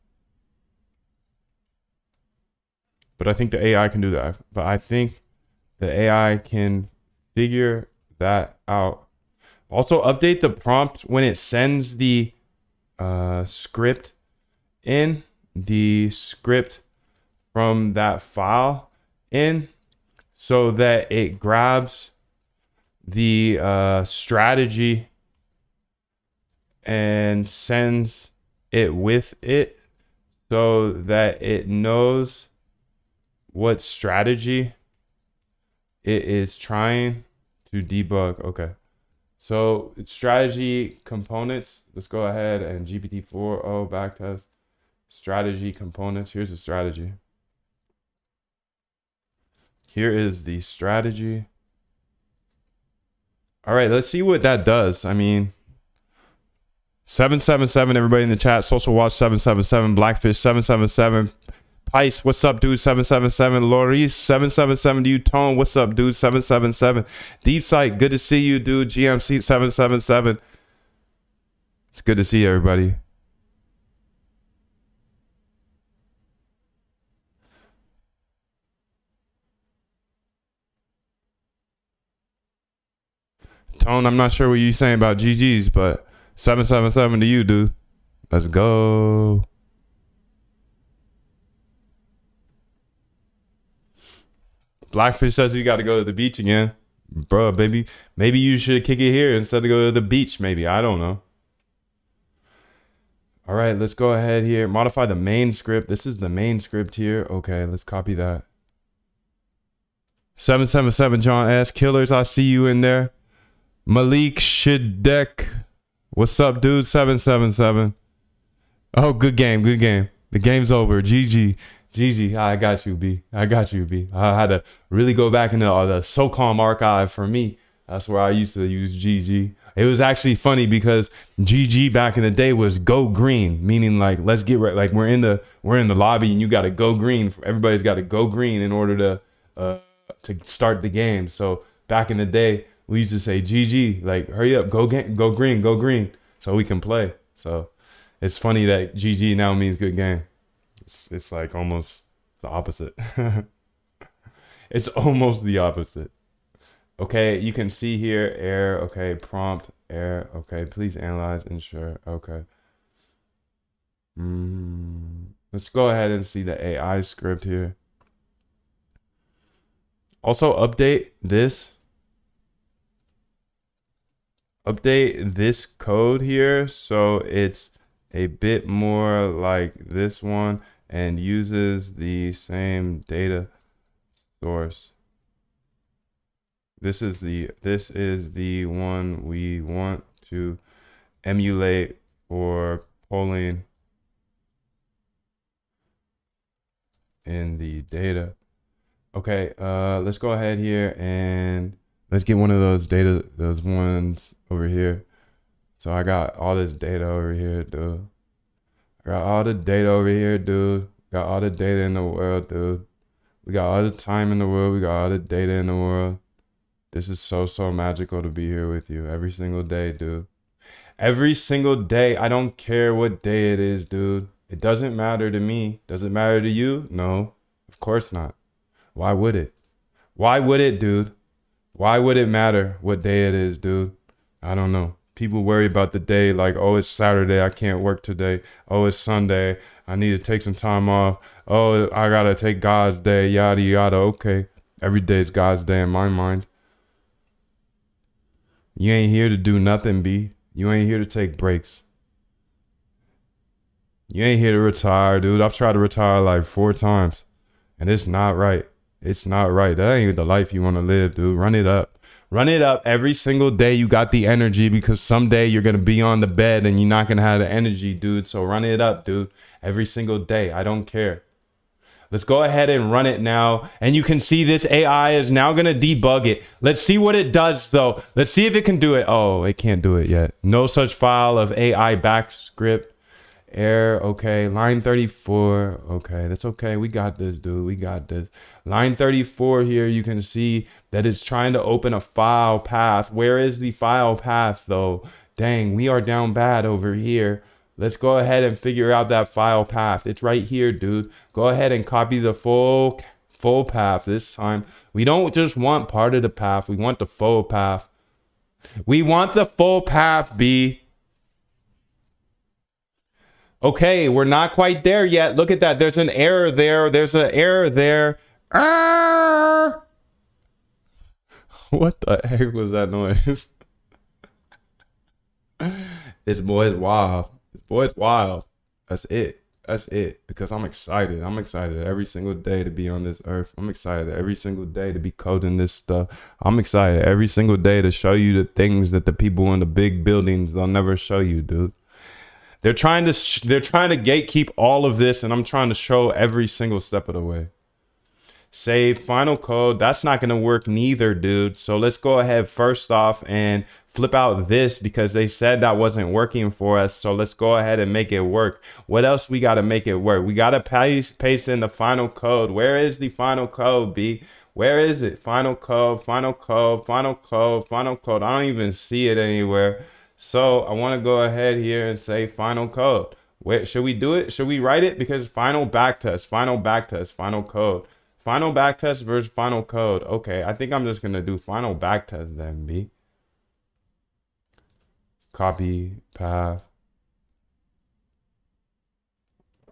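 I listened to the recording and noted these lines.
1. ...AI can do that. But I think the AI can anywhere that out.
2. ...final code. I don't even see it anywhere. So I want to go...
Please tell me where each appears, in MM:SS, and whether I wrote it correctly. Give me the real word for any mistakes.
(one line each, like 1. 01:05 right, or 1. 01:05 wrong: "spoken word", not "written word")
1. 00:03 wrong: "figure", not "anywhere"
2. 06:07 right.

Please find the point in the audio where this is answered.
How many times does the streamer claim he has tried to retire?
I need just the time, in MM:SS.
04:16.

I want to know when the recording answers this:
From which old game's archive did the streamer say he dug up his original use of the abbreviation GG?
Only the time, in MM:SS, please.
02:06.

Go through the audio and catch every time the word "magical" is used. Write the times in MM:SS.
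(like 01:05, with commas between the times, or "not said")
03:37.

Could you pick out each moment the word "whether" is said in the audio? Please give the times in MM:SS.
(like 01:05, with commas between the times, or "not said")
not said.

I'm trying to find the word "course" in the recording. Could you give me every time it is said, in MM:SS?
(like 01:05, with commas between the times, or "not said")
03:47.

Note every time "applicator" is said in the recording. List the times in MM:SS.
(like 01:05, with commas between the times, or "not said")
not said.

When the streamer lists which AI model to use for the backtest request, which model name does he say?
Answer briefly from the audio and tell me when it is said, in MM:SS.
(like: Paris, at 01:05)
GPT-4o, at 00:42.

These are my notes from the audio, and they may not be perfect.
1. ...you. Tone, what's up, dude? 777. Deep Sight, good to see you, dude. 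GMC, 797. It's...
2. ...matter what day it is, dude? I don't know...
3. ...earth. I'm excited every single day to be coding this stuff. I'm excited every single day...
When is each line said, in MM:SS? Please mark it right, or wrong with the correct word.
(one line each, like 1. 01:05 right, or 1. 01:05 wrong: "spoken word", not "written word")
1. 01:05 wrong: "777", not "797"
2. 03:52 right
3. 05:33 right.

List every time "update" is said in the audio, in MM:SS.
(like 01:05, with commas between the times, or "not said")
00:10, 02:50, 02:54.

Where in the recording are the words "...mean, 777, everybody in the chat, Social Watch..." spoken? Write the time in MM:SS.
00:55.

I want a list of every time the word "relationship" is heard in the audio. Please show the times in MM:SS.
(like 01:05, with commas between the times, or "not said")
not said.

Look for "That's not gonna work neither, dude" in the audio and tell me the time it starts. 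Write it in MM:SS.
05:49.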